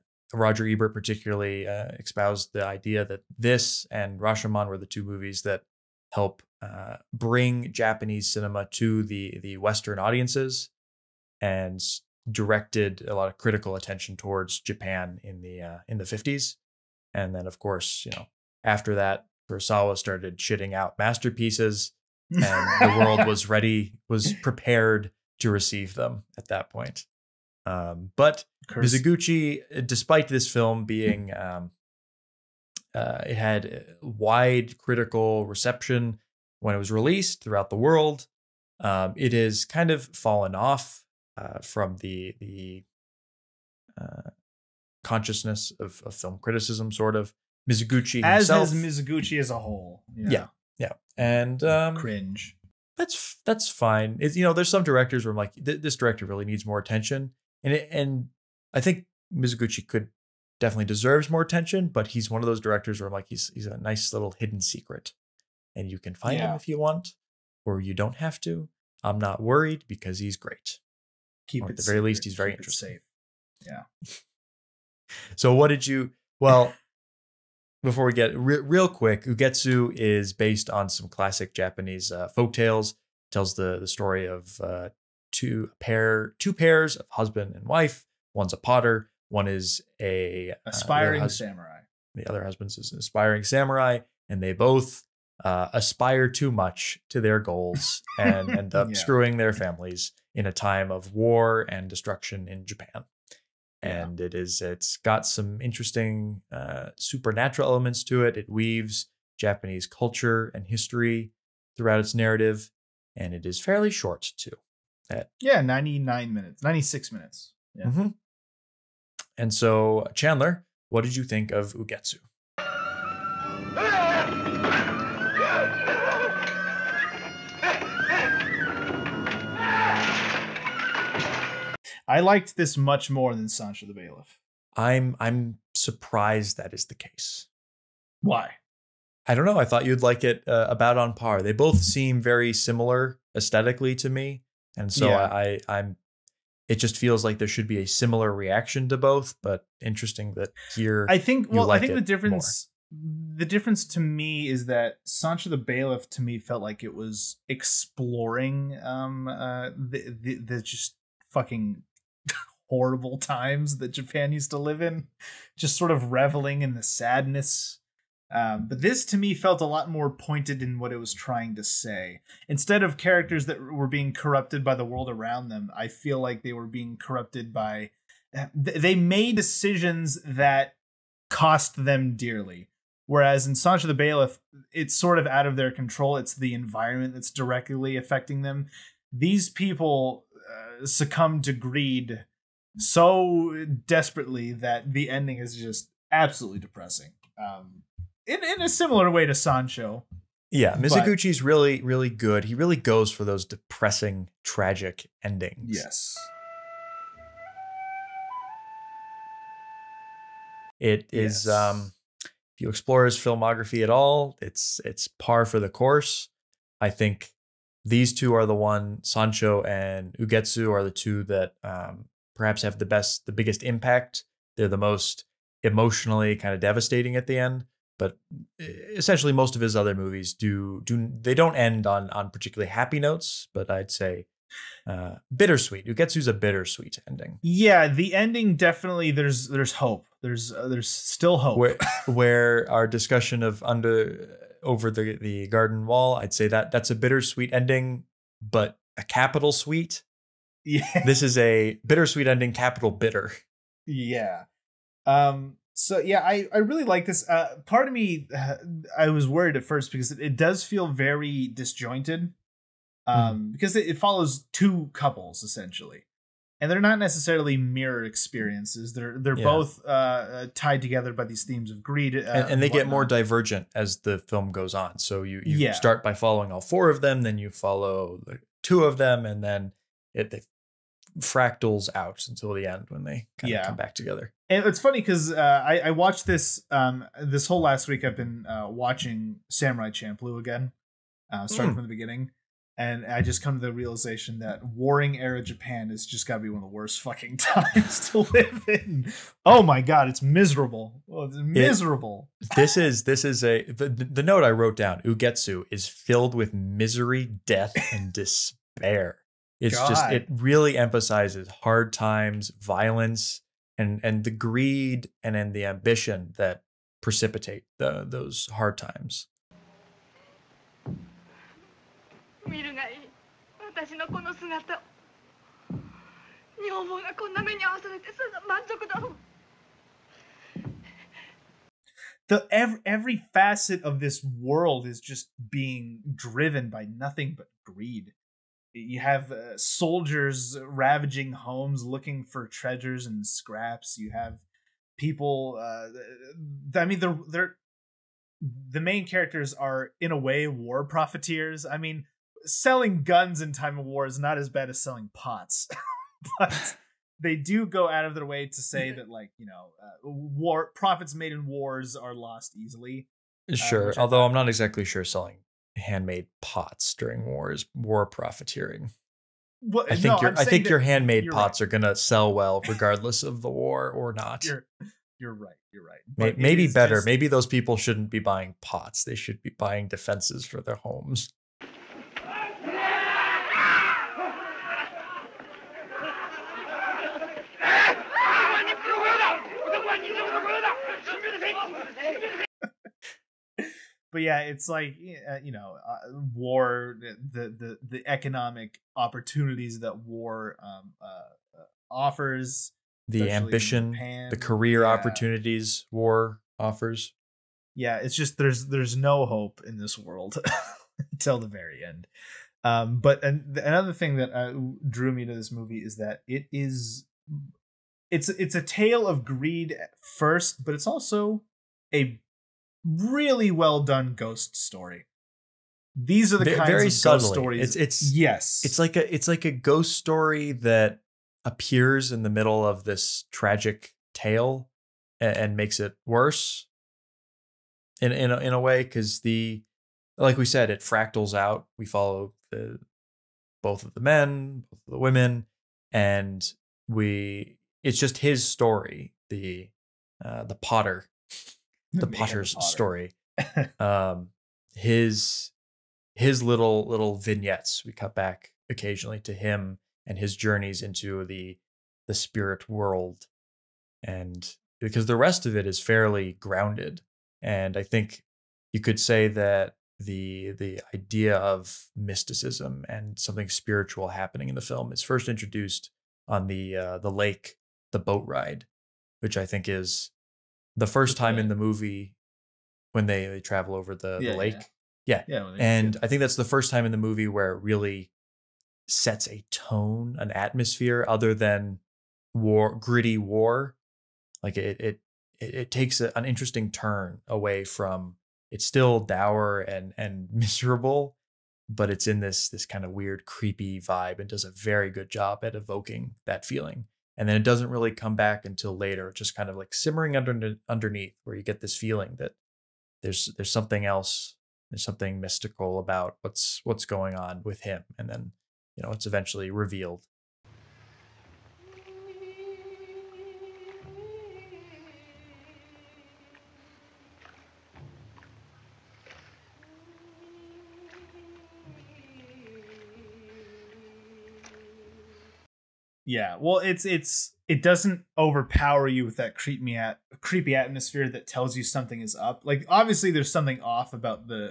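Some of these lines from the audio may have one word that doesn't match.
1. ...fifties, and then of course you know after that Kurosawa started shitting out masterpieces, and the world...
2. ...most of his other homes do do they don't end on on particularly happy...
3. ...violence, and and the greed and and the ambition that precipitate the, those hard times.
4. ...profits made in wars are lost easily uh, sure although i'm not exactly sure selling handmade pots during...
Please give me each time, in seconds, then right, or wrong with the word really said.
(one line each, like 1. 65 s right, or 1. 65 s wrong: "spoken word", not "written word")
1. 16 s right
2. 229 s wrong: "movies", not "homes"
3. 312 s right
4. 360 s right.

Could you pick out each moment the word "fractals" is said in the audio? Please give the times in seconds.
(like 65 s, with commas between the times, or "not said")
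281 s, 440 s.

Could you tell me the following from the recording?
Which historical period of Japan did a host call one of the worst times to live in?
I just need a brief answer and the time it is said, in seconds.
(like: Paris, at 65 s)
Warring era, at 294 s.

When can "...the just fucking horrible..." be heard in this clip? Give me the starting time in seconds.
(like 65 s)
160 s.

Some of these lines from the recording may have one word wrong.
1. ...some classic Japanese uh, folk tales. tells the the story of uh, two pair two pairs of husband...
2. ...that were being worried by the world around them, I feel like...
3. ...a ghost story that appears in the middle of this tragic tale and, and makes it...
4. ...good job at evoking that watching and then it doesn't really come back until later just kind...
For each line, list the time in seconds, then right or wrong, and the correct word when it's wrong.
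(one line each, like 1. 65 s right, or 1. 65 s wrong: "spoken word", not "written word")
1. 80 s right
2. 173 s wrong: "corrupted", not "worried"
3. 429 s right
4. 504 s wrong: "feeling", not "watching".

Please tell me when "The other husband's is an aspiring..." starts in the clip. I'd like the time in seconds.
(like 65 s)
92 s.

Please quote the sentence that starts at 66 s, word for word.
him if you want, or you don't have to.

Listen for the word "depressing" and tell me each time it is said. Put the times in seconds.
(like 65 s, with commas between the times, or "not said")
196 s, 203 s.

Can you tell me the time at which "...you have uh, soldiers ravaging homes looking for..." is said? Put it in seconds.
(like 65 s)
338 s.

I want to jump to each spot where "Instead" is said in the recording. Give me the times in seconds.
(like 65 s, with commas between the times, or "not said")
172 s.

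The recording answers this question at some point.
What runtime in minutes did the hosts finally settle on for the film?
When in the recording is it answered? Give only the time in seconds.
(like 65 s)
116 s.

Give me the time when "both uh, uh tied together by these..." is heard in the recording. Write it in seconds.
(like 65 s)
269 s.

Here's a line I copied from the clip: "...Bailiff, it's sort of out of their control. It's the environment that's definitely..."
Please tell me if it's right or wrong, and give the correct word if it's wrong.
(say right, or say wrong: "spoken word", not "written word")
wrong: "directly", not "definitely".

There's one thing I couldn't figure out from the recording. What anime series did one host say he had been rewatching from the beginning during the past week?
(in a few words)
Samurai Champloo.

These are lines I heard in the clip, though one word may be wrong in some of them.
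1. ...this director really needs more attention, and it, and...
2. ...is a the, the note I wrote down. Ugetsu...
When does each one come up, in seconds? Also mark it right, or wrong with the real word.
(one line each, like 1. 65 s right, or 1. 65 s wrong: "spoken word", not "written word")
1. 55 s right
2. 303 s right.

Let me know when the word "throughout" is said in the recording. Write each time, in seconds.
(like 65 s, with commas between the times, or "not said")
37 s, 111 s.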